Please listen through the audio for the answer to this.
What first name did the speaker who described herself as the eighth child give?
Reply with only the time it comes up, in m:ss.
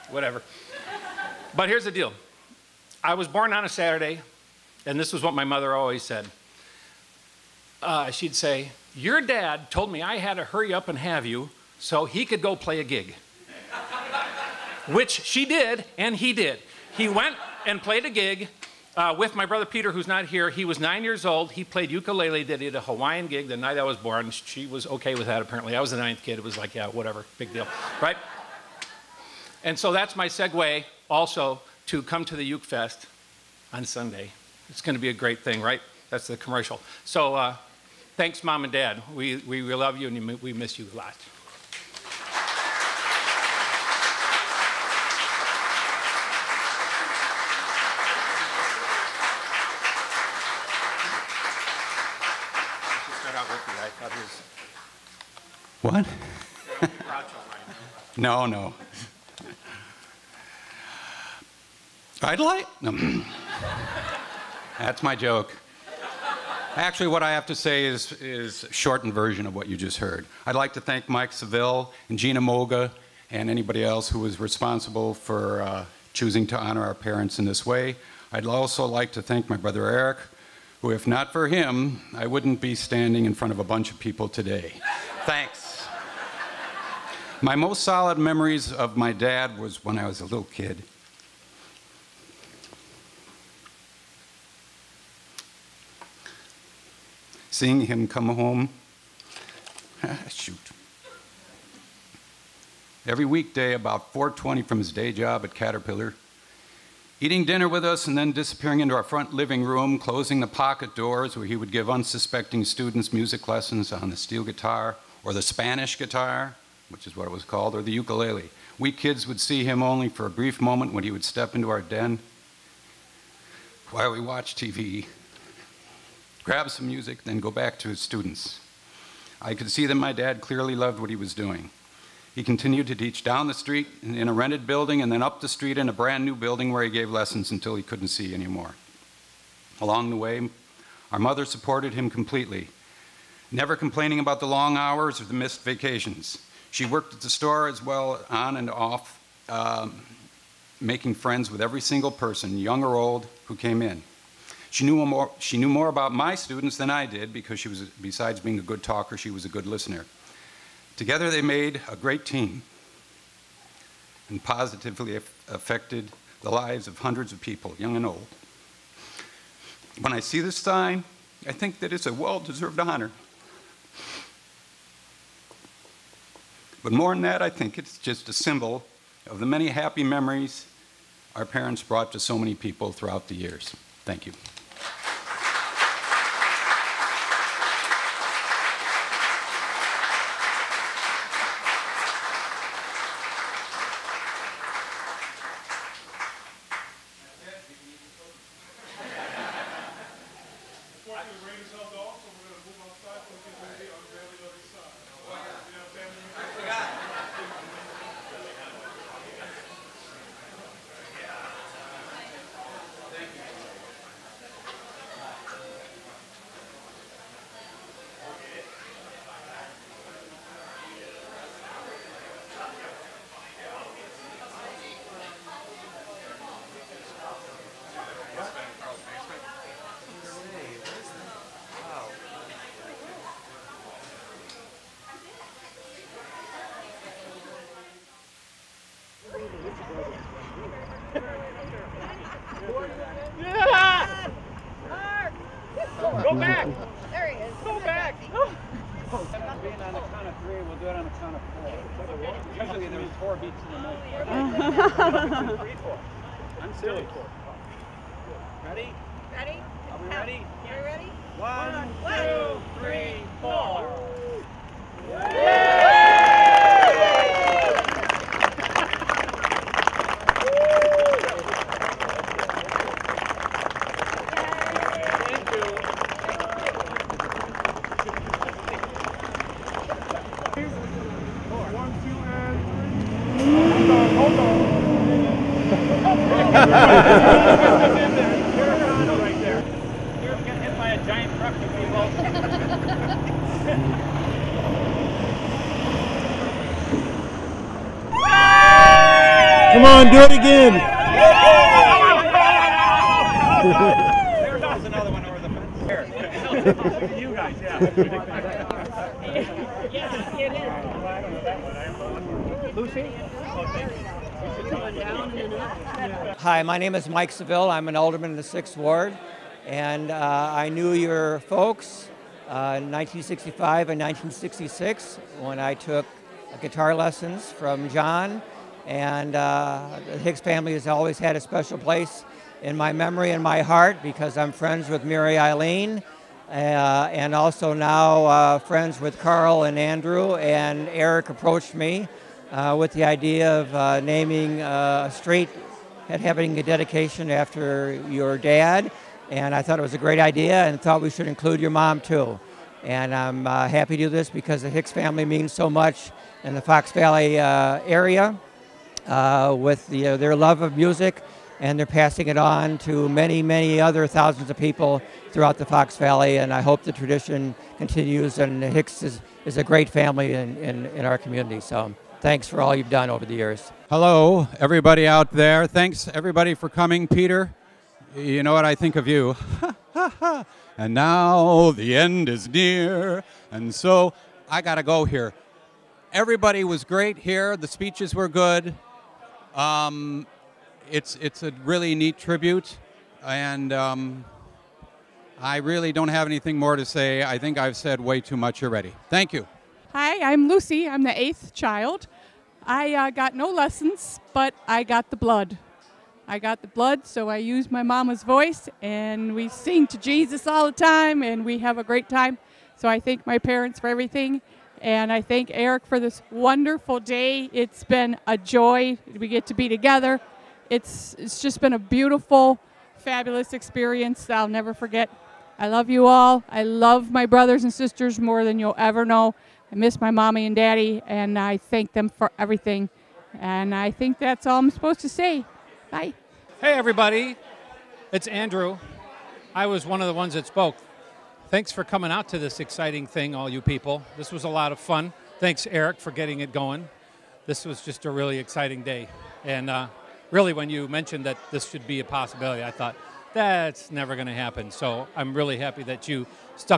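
6:40.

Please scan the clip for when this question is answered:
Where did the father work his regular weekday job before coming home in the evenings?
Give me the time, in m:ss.
1:45.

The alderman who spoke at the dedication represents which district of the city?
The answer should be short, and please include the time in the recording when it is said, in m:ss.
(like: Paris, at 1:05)
6th Ward, at 5:18.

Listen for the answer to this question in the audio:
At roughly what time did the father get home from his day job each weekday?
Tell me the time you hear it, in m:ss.
1:44.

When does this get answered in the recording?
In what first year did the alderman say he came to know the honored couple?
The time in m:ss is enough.
5:22.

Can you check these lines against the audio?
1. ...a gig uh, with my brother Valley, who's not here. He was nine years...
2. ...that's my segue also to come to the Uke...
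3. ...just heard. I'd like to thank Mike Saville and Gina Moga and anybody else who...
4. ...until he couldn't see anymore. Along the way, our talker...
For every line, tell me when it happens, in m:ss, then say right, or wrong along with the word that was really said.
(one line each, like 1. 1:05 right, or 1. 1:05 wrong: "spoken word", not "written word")
1. 0:18 wrong: "Peter", not "Valley"
2. 0:29 right
3. 1:09 right
4. 2:17 wrong: "mother", not "talker".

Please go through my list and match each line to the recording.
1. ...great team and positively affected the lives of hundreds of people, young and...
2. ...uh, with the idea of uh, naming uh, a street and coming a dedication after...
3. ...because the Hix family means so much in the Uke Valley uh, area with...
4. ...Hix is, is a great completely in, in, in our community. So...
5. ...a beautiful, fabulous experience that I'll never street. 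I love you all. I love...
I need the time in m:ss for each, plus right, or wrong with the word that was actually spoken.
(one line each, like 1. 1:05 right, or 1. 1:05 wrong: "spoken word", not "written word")
1. 2:41 right
2. 5:42 wrong: "having", not "coming"
3. 5:54 wrong: "Fox", not "Uke"
4. 6:08 wrong: "family", not "completely"
5. 7:01 wrong: "forget", not "street".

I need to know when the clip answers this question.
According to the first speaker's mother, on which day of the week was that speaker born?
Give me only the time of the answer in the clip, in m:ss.
0:03.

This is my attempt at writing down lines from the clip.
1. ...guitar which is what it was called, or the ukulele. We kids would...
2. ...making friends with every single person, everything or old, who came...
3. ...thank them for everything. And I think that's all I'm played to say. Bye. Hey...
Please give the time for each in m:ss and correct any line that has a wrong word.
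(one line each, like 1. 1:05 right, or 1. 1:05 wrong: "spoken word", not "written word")
1. 1:55 right
2. 2:30 wrong: "young", not "everything"
3. 7:11 wrong: "supposed", not "played".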